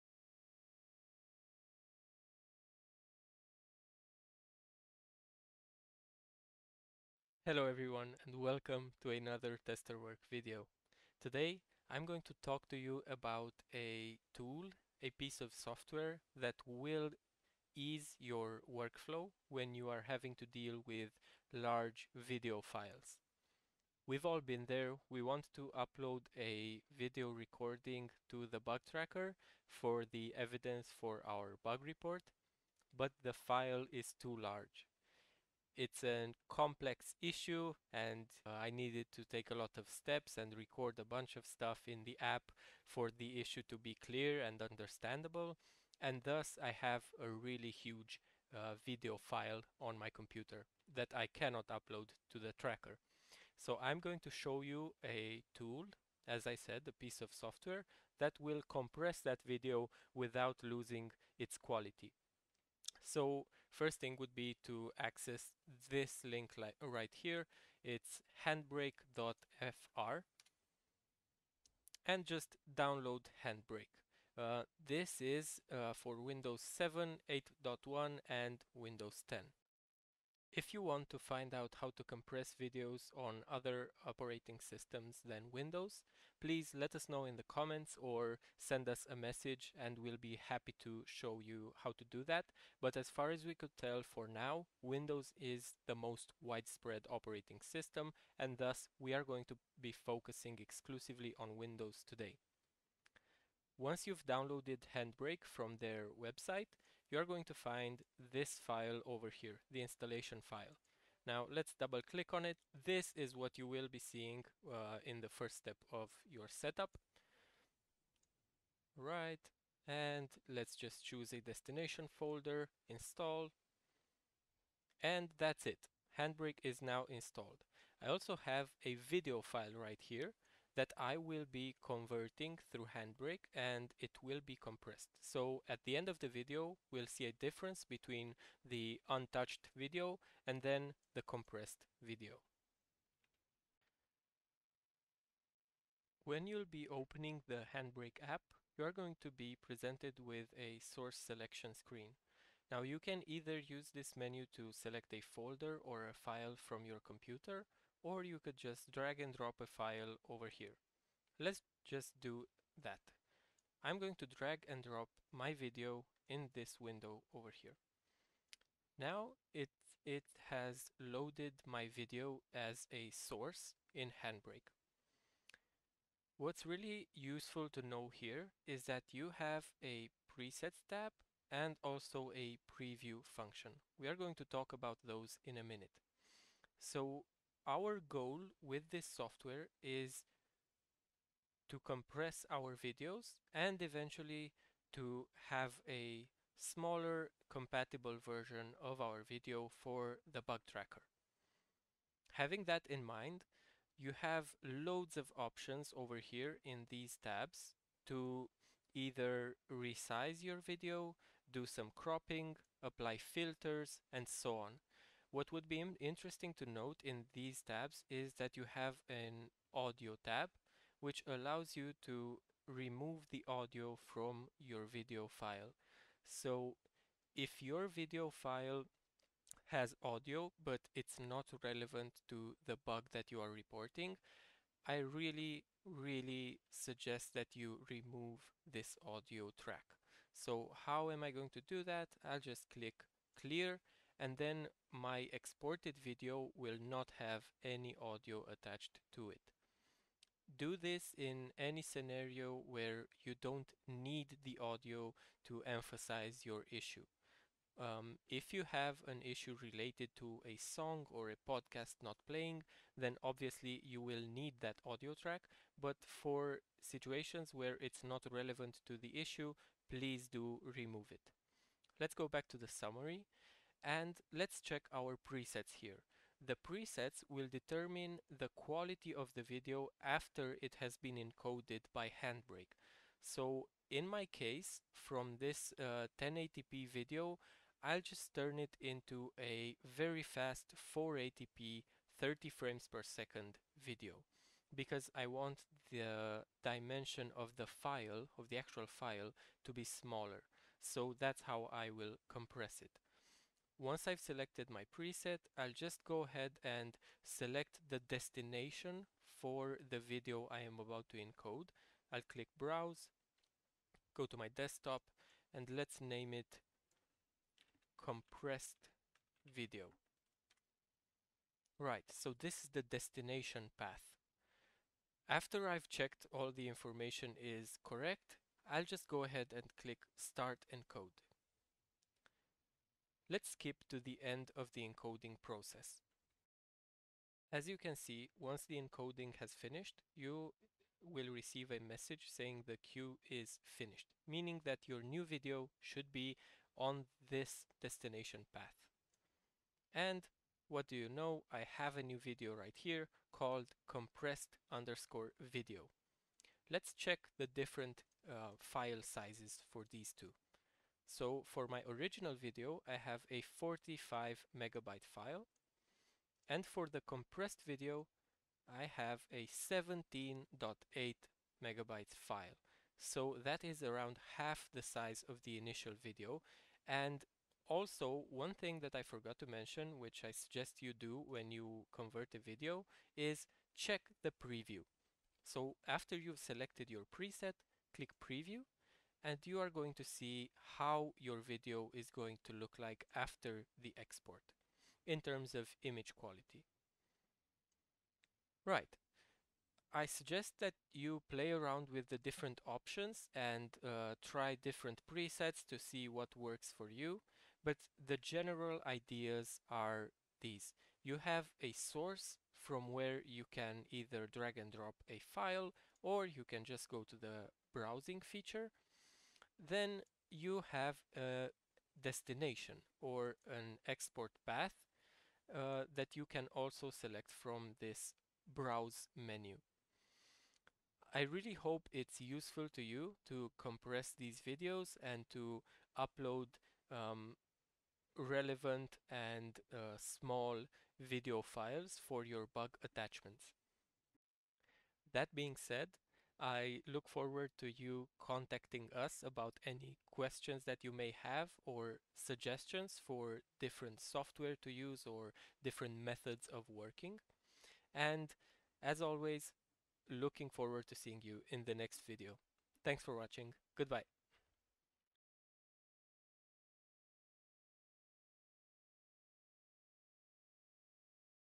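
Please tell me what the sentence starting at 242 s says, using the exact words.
I'll just click clear and then my exported video will not have any audio attached to it.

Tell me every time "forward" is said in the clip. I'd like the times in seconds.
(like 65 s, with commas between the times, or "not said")
447 s, 460 s.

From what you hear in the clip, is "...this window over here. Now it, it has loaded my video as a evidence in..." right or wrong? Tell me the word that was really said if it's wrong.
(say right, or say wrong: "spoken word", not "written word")
wrong: "source", not "evidence".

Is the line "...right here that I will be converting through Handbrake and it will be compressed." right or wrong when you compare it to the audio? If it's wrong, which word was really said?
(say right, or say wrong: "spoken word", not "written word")
right.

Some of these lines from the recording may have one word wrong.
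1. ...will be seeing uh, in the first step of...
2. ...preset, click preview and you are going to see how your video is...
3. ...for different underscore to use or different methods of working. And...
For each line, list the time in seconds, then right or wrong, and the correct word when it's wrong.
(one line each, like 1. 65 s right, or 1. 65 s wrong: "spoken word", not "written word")
1. 113 s right
2. 387 s right
3. 453 s wrong: "software", not "underscore".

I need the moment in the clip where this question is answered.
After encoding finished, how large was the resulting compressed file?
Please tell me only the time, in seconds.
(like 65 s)
369 s.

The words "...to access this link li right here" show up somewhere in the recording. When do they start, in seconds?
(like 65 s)
64 s.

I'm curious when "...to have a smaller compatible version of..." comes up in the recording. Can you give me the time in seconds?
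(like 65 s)
194 s.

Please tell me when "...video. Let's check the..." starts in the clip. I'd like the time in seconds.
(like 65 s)
355 s.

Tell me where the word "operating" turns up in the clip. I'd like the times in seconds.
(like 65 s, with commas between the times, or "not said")
84 s, 97 s.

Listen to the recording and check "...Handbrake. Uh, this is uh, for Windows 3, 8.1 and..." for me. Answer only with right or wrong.
wrong.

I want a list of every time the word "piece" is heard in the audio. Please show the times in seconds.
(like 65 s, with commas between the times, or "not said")
15 s, 56 s.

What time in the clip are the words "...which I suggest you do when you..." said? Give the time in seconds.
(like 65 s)
379 s.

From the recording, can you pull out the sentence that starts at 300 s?
So that's how I will compress it.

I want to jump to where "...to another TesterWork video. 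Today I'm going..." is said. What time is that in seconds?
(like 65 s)
9 s.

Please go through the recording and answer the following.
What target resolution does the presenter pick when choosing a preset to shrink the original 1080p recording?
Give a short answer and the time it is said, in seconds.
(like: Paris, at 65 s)
480p, at 290 s.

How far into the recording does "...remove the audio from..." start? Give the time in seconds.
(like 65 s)
222 s.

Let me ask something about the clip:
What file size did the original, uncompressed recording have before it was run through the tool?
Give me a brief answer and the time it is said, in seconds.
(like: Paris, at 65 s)
45 MB, at 363 s.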